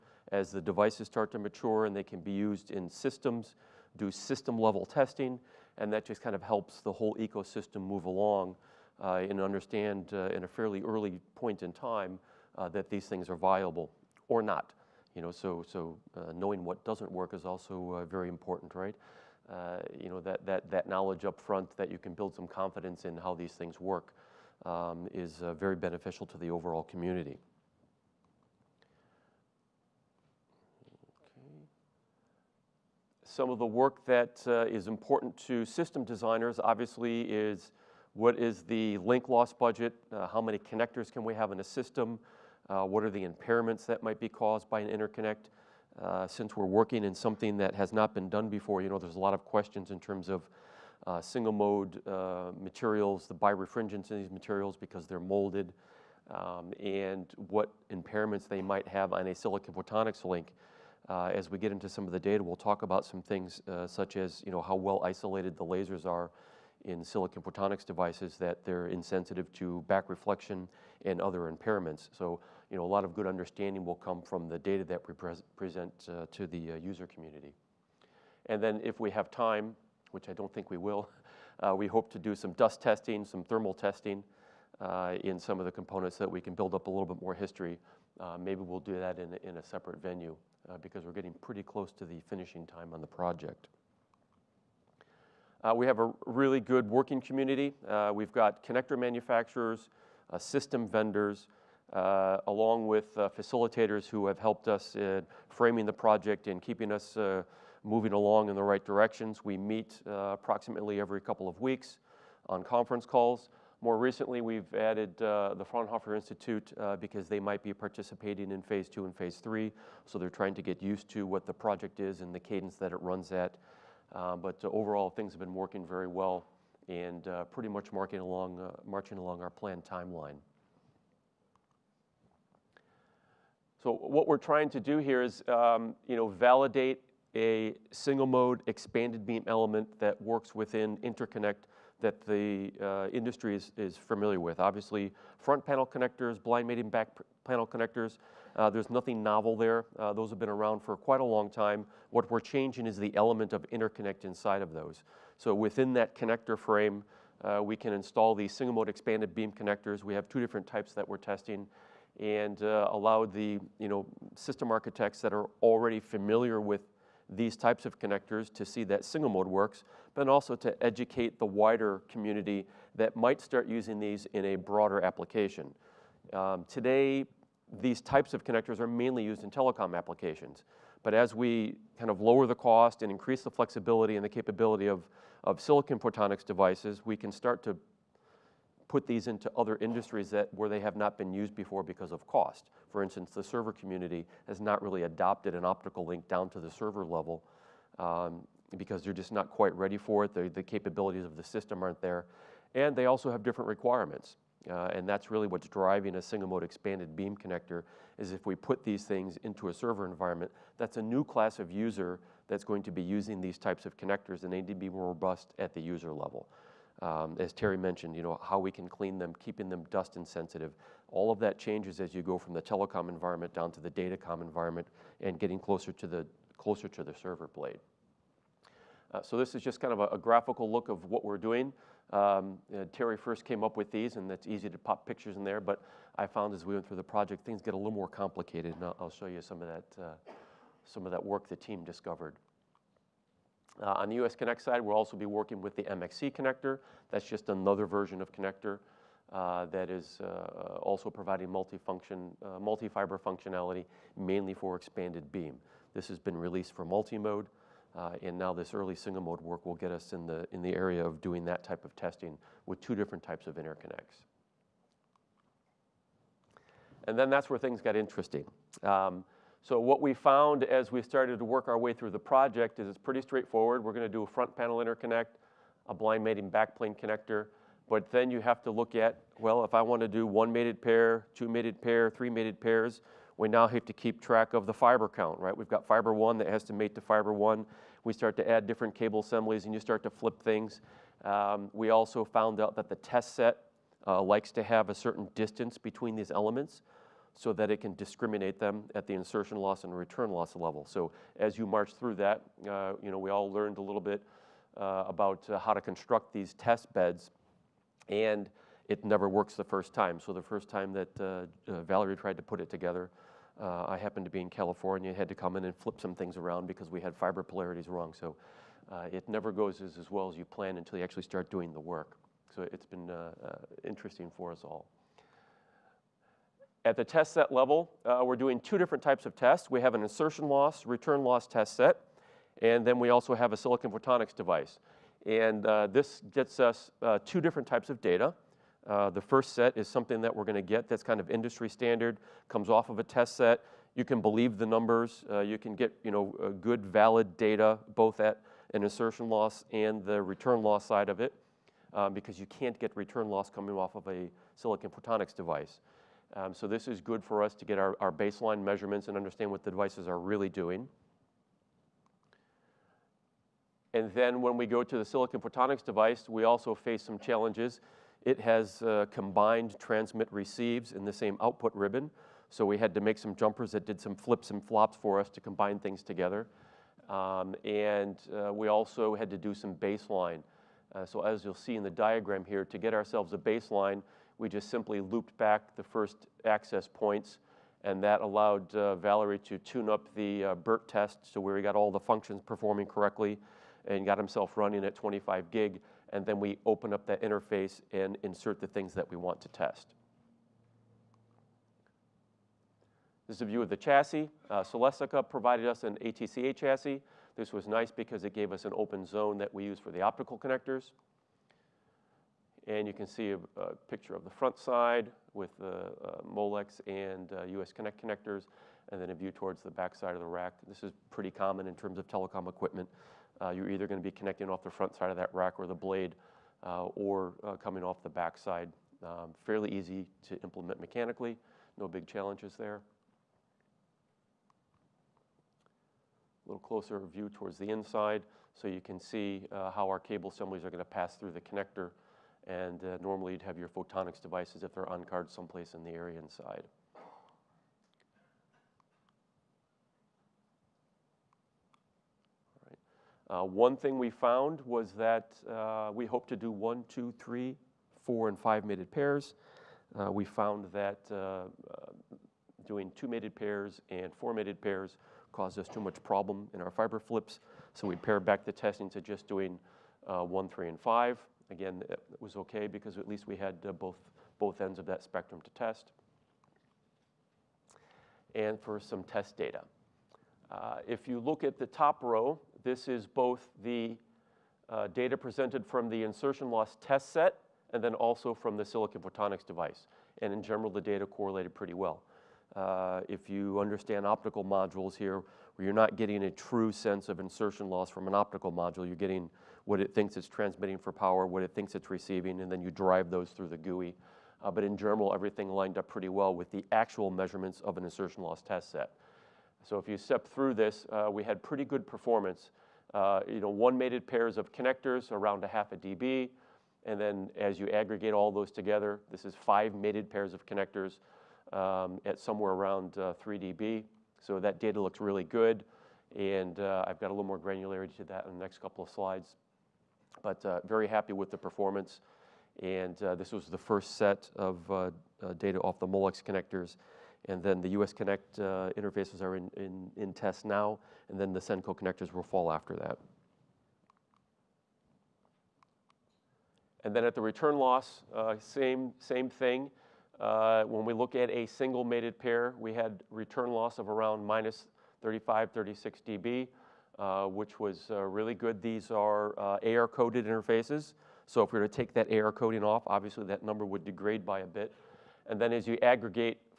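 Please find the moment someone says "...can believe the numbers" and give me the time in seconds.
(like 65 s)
344 s.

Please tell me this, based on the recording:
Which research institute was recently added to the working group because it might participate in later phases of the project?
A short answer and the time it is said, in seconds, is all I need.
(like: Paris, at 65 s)
Fraunhofer Institute, at 115 s.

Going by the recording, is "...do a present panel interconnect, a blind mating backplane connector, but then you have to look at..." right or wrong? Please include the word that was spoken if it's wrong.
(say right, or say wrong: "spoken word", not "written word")
wrong: "front", not "present".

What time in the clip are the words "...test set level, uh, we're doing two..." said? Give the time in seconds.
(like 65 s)
327 s.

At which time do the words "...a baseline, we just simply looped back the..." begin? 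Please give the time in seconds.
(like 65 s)
383 s.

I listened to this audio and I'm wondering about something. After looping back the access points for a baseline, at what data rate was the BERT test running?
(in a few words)
25 gig.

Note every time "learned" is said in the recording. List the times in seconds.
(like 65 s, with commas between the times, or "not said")
303 s.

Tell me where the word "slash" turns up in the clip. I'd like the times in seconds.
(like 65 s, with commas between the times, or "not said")
not said.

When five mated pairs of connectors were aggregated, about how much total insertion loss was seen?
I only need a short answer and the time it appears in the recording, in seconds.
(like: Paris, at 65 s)
3 dB, at 523 s.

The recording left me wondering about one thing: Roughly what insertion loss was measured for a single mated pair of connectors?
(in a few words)
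half a dB.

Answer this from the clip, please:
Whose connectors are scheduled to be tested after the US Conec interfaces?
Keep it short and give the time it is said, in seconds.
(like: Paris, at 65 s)
Senko, at 541 s.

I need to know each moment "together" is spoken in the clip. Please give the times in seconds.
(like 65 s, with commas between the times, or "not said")
312 s, 376 s, 518 s.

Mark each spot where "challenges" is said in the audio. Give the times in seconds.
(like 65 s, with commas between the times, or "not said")
367 s, 432 s.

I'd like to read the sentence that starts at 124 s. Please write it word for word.
Uh, but uh, overall, things have been working very well and uh, pretty much along, marching along our planned timeline.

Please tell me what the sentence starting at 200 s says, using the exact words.
The, the capabilities of the system aren't there.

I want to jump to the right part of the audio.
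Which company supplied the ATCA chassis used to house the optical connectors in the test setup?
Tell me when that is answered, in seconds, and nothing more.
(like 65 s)
404 s.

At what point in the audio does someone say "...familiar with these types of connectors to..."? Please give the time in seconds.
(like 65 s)
165 s.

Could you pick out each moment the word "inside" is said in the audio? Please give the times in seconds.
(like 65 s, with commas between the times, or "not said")
154 s, 437 s, 446 s.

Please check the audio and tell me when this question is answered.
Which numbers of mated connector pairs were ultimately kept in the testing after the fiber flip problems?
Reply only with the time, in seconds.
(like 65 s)
470 s.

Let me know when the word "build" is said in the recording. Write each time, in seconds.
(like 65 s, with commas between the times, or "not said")
22 s, 86 s.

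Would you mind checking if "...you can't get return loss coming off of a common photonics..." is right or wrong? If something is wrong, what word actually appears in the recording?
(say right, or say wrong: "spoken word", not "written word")
wrong: "silicon", not "common".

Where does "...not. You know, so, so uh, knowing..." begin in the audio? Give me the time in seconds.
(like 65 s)
14 s.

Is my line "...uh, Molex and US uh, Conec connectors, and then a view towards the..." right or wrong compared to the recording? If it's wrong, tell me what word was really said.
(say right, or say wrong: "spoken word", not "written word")
right.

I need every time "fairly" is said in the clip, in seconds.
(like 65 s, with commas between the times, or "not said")
10 s, 429 s.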